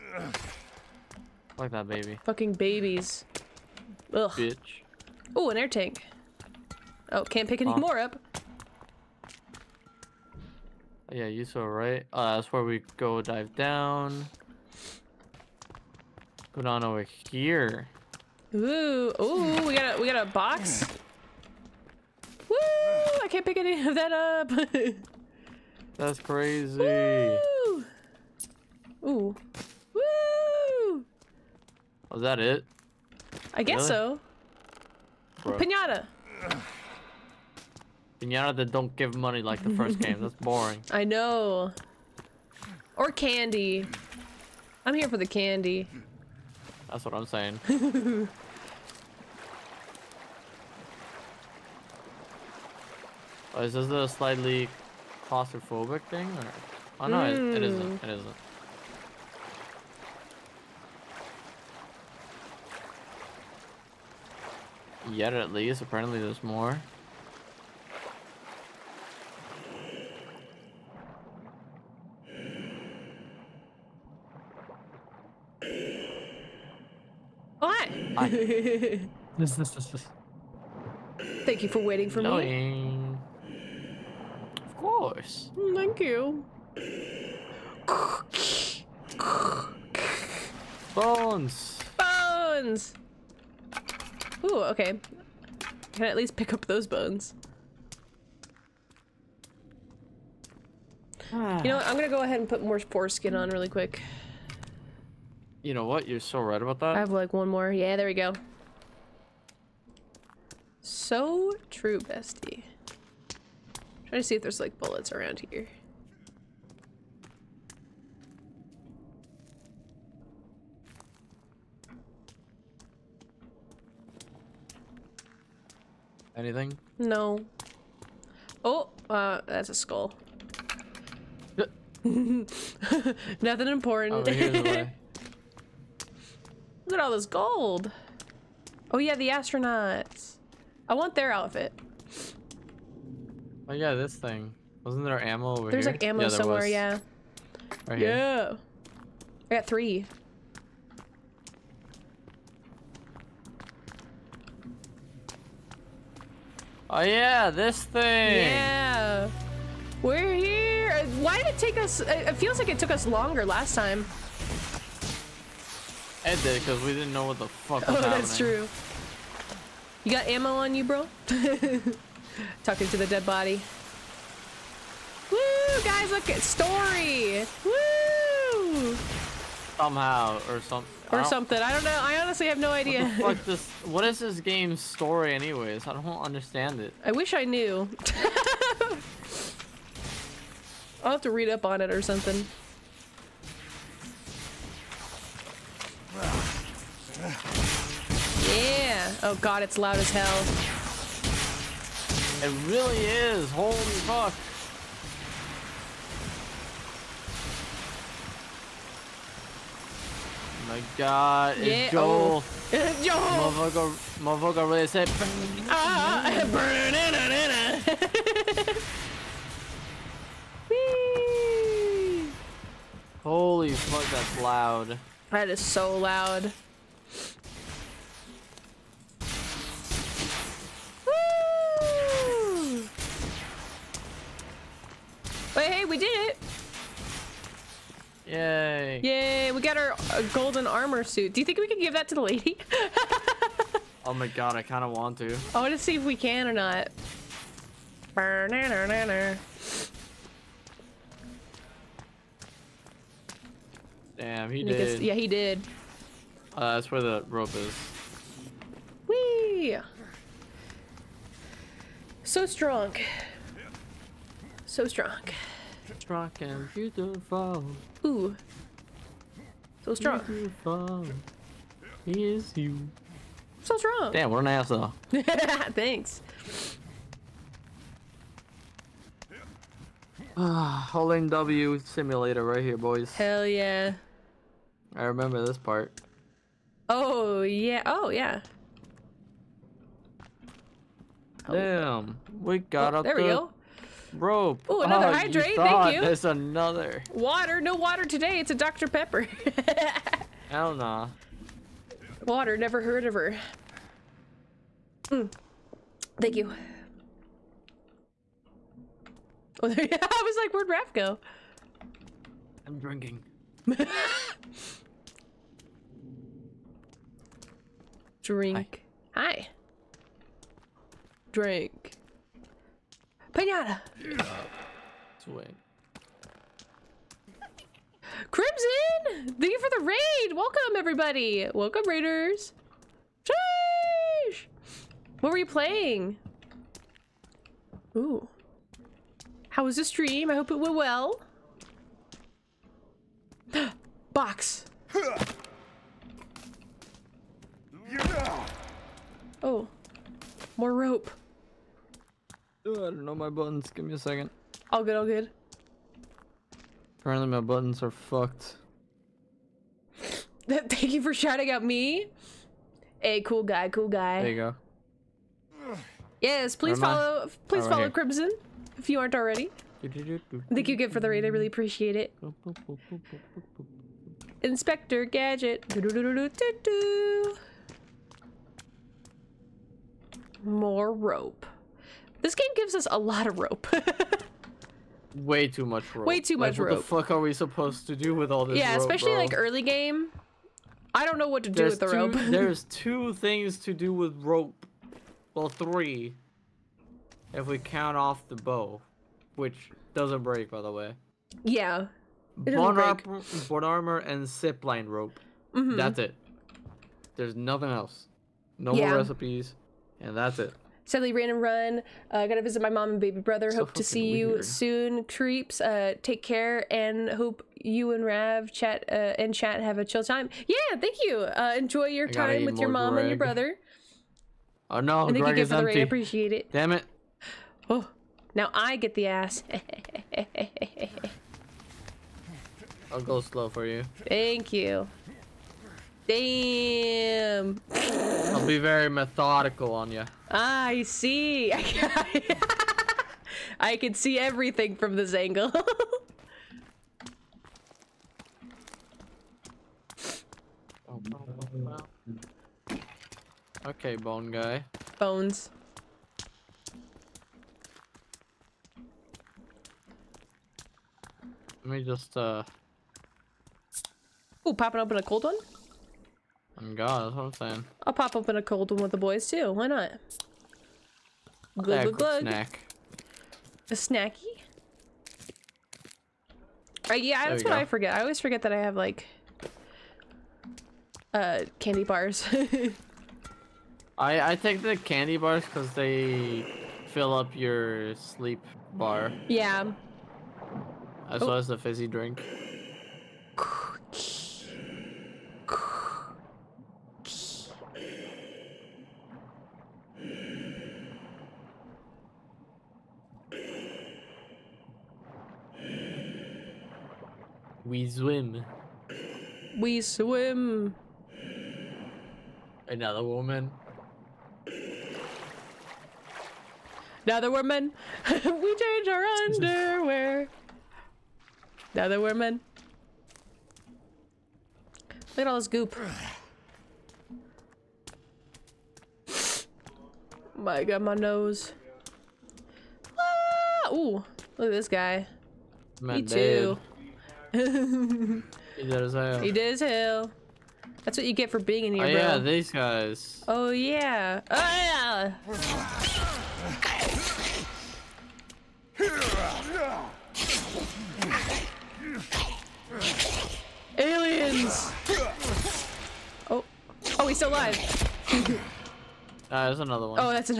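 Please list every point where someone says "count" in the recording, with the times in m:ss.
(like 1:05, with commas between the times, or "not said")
6:37.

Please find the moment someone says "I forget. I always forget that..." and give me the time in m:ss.
7:57.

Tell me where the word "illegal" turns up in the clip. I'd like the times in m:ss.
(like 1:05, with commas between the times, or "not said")
not said.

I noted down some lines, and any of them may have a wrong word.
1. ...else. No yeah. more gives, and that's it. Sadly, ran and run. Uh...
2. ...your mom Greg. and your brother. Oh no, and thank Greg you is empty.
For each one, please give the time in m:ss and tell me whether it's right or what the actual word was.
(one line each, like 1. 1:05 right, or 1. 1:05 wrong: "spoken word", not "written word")
1. 6:47 wrong: "recipes", not "gives"
2. 7:02 right.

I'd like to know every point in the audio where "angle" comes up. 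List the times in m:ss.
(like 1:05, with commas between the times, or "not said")
7:25.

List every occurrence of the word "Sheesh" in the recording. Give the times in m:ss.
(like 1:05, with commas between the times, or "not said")
5:33.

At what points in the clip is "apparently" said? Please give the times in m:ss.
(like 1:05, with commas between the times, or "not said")
1:05, 5:57.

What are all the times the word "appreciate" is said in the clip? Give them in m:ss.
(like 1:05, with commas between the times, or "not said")
6:11, 7:05.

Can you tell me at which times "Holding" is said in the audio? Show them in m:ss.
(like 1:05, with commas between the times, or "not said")
4:40.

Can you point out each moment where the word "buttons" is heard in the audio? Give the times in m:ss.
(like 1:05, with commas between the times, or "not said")
5:53, 5:57.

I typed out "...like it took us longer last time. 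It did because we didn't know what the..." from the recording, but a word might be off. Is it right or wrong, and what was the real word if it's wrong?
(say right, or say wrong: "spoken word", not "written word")
right.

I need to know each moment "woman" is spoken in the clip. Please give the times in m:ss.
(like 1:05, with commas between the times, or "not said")
8:33, 8:37, 8:42.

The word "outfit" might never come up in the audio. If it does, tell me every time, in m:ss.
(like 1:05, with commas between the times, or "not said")
2:21.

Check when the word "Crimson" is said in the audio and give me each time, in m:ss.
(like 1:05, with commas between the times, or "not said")
5:28, 6:07.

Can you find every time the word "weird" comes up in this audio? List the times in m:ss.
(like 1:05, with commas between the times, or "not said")
6:54.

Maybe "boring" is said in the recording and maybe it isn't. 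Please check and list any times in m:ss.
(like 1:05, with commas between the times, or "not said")
0:40.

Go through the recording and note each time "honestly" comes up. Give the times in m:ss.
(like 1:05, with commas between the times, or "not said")
3:02.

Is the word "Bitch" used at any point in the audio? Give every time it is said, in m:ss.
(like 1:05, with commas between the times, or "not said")
0:04.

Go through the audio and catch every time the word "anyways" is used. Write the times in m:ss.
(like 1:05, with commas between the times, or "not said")
3:05.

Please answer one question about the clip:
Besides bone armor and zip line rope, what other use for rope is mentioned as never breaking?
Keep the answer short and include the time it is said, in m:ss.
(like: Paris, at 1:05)
The bow, at 6:38.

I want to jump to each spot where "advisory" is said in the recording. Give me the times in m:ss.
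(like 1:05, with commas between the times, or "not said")
not said.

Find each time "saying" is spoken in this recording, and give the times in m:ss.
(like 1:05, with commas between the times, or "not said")
0:47, 7:47.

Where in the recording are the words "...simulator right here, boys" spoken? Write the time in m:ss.
4:41.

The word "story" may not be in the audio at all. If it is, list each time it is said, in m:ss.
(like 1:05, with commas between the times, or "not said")
2:56, 3:04.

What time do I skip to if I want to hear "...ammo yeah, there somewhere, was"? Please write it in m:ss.
2:26.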